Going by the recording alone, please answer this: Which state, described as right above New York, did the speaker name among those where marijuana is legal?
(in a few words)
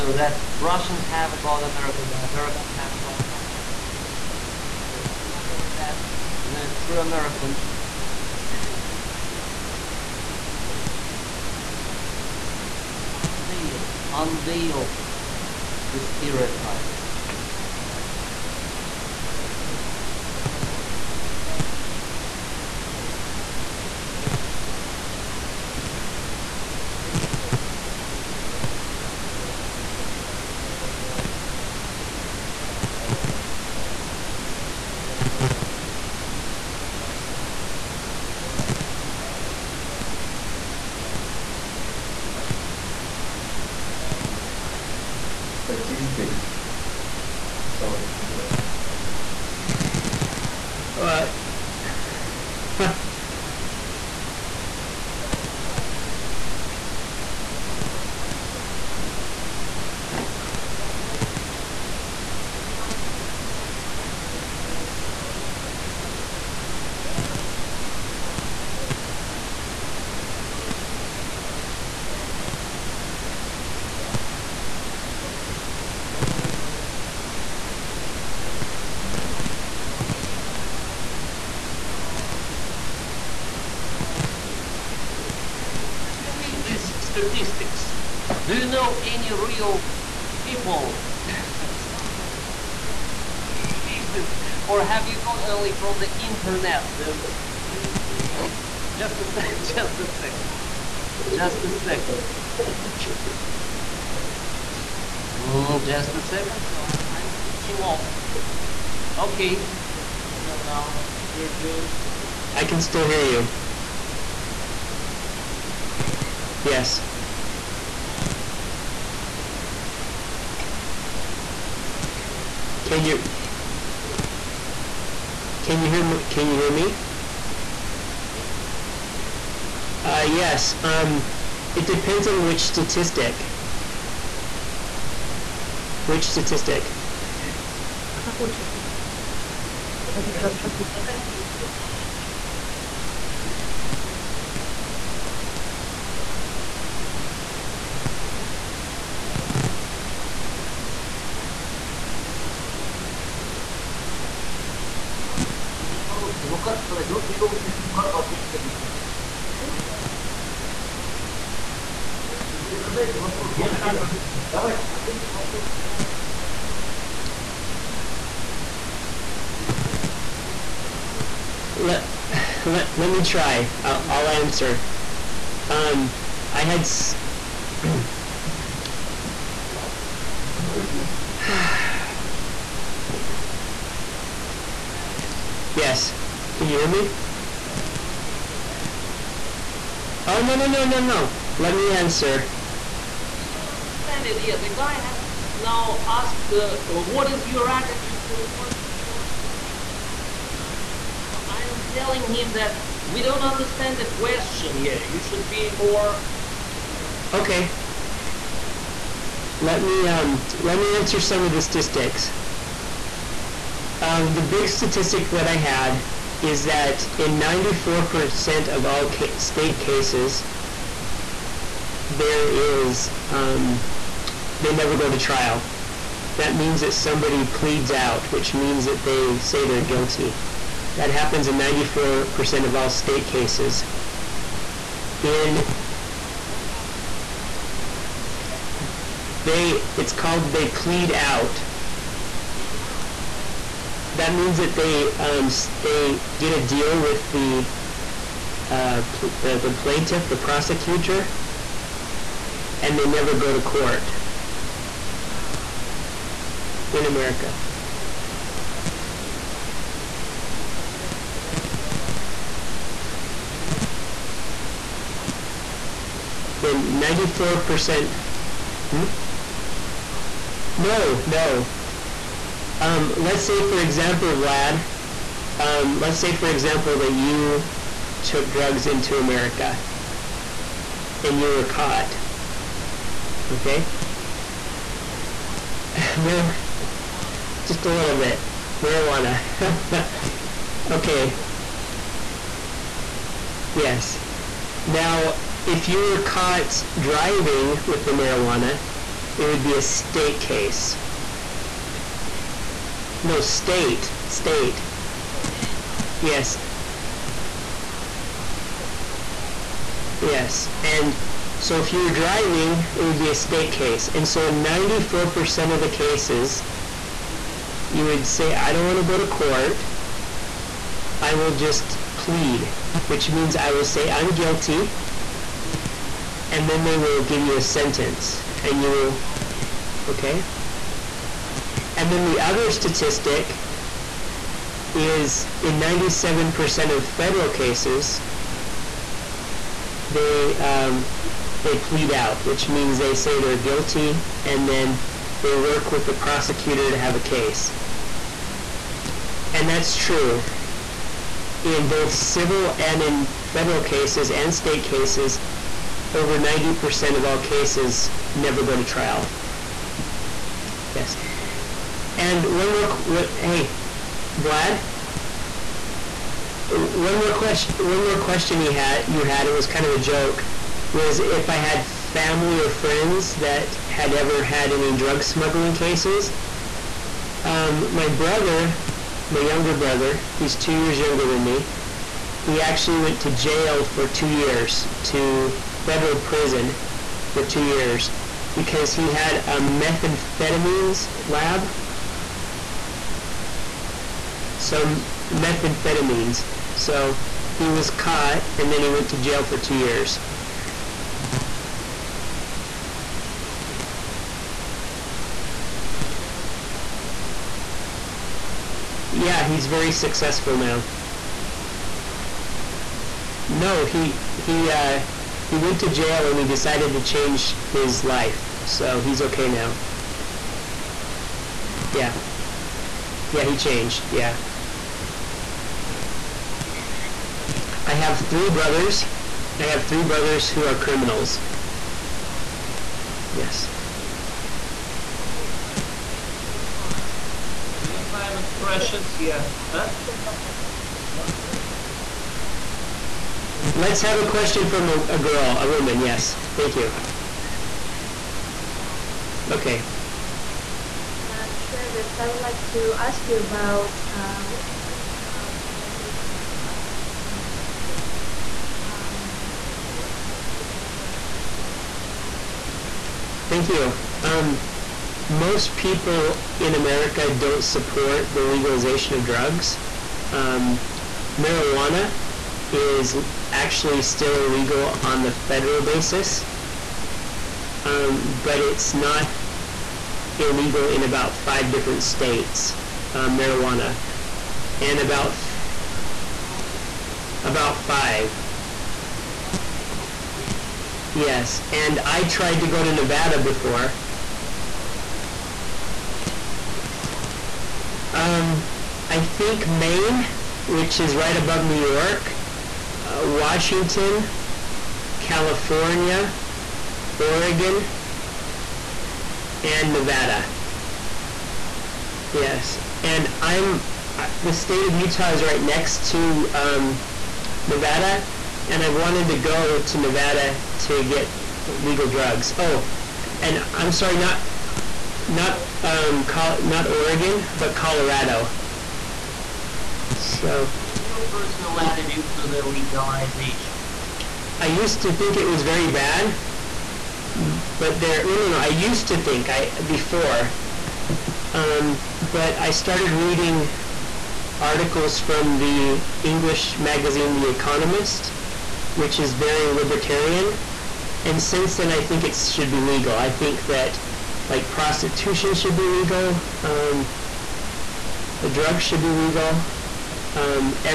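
Maine.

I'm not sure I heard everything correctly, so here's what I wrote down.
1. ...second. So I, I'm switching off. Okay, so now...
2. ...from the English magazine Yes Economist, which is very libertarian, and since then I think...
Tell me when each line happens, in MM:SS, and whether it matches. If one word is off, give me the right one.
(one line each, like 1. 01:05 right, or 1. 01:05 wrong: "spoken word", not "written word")
1. 01:46 right
2. 09:05 wrong: "The", not "Yes".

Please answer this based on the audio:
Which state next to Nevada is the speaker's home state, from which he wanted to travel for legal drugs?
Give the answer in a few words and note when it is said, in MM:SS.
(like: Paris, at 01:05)
Utah, at 08:35.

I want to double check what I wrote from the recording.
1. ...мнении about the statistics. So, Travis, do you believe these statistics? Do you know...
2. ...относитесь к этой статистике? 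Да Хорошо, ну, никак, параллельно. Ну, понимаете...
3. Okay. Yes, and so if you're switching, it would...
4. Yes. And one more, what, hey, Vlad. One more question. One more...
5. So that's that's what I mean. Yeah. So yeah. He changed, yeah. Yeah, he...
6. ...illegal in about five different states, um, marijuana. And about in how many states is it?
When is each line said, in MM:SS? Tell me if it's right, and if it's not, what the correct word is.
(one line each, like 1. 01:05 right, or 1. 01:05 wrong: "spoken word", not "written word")
1. 01:21 right
2. 02:38 right
3. 05:06 wrong: "driving", not "switching"
4. 06:00 right
5. 06:59 right
6. 08:00 right.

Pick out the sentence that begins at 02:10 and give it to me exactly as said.
Um, it depends on which statistic.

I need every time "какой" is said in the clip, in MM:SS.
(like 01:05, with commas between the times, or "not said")
02:44, 02:50.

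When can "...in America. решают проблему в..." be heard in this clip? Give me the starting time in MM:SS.
04:16.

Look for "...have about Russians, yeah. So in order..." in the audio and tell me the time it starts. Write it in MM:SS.
00:02.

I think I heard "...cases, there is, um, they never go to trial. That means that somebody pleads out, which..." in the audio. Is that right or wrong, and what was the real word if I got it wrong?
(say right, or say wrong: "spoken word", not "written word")
right.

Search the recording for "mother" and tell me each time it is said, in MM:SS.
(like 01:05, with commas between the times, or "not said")
not said.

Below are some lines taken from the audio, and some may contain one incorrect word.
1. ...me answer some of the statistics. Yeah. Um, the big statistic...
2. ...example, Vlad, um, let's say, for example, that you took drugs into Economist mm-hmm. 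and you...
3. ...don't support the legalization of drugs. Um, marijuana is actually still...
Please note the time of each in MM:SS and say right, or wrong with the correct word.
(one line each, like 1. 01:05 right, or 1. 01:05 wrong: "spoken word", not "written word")
1. 03:30 right
2. 04:33 wrong: "America", not "Economist"
3. 07:47 right.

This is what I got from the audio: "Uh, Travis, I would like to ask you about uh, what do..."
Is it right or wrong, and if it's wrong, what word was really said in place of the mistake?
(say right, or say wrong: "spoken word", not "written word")
right.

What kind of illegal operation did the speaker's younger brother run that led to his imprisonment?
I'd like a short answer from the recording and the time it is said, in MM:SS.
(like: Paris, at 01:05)
Methamphetamines lab, at 06:29.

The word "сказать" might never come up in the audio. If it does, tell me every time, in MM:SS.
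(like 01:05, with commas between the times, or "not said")
02:36.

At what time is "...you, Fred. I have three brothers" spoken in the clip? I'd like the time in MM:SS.
07:07.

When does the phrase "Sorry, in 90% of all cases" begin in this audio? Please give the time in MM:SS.
03:57.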